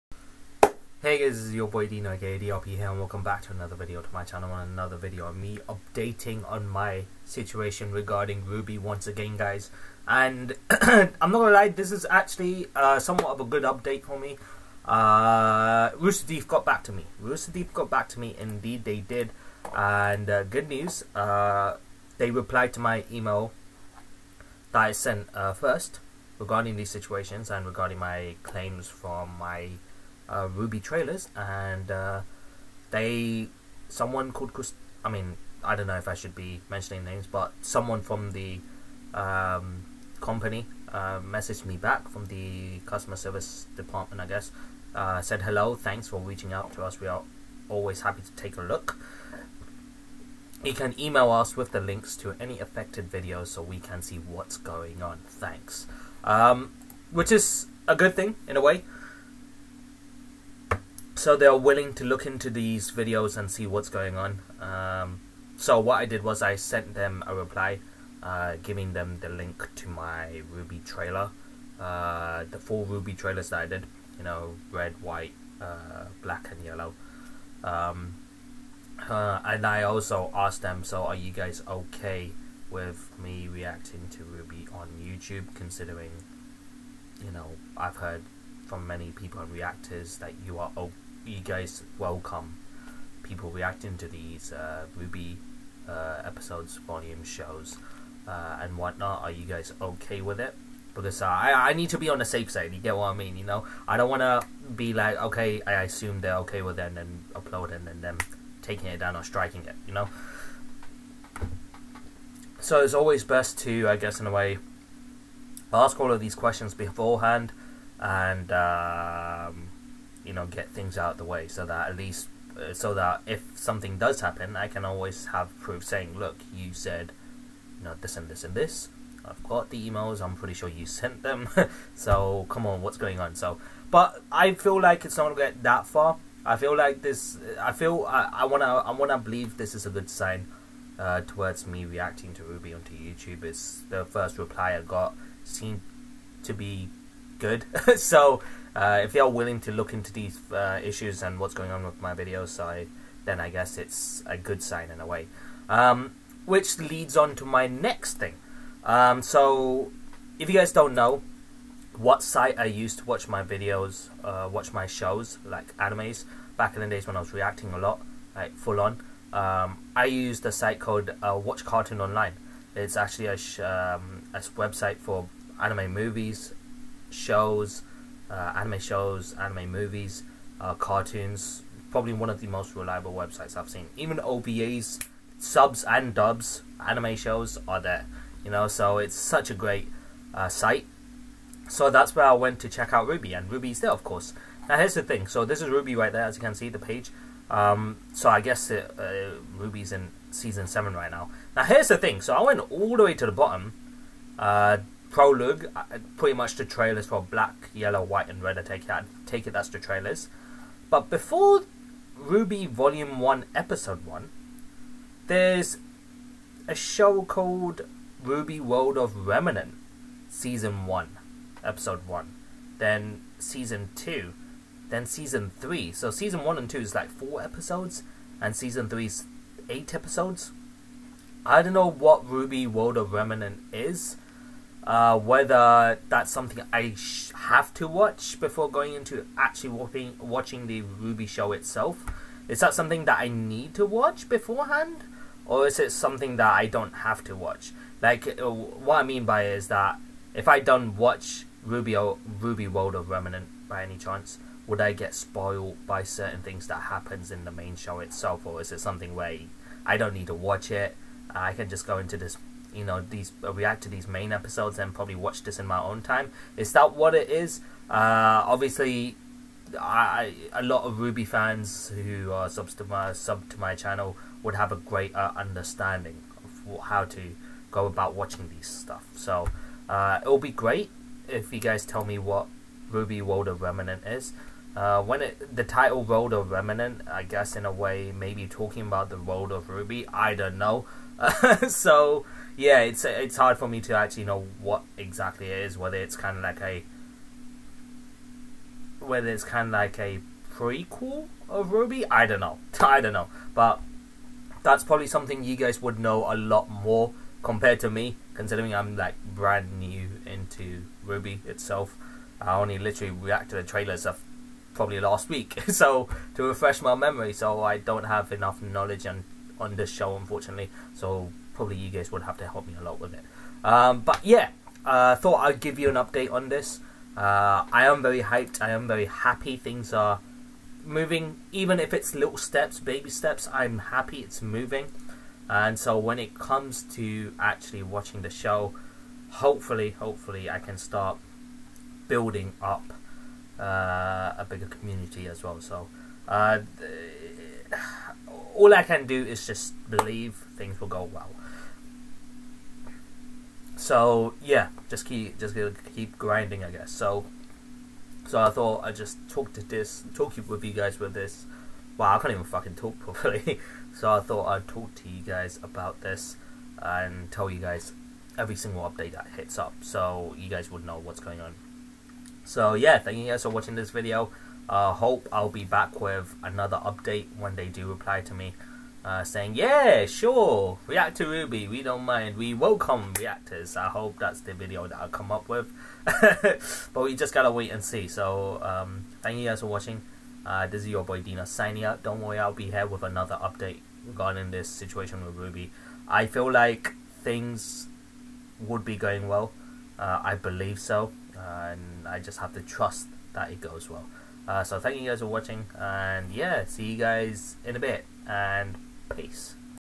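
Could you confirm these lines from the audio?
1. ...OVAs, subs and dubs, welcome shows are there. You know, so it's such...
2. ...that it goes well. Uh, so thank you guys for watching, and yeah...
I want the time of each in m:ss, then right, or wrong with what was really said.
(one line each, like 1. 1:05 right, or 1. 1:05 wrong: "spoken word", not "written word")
1. 3:04 wrong: "anime", not "welcome"
2. 6:43 right.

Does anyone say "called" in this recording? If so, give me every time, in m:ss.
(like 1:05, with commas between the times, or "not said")
0:34, 2:50, 3:37.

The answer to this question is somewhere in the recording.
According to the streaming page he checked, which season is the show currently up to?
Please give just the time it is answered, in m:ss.
3:20.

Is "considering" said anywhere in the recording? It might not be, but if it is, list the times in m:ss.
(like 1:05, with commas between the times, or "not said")
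1:25, 5:08.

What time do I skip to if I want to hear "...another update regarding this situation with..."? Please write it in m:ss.
6:33.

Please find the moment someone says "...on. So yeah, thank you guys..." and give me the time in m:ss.
6:11.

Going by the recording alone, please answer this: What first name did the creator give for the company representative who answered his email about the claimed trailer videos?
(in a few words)
Chris.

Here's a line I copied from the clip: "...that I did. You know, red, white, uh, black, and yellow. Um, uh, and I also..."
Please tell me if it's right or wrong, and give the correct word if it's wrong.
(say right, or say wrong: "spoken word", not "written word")
right.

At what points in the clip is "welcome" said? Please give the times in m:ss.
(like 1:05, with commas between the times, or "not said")
0:02, 1:31, 6:22.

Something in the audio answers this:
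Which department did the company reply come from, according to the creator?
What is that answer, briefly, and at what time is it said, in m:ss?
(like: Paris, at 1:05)
customer service, at 0:42.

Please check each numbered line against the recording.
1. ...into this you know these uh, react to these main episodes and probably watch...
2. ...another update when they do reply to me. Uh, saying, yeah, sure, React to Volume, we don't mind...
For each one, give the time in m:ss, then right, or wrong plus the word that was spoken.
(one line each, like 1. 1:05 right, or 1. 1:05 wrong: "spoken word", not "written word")
1. 4:21 right
2. 6:16 wrong: "RWBY", not "Volume".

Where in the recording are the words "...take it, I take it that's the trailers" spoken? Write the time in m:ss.
3:28.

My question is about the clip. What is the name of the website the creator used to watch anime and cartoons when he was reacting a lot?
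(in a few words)
Watch Cartoon Online.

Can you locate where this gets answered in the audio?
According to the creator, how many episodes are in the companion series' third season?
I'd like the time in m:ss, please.
3:49.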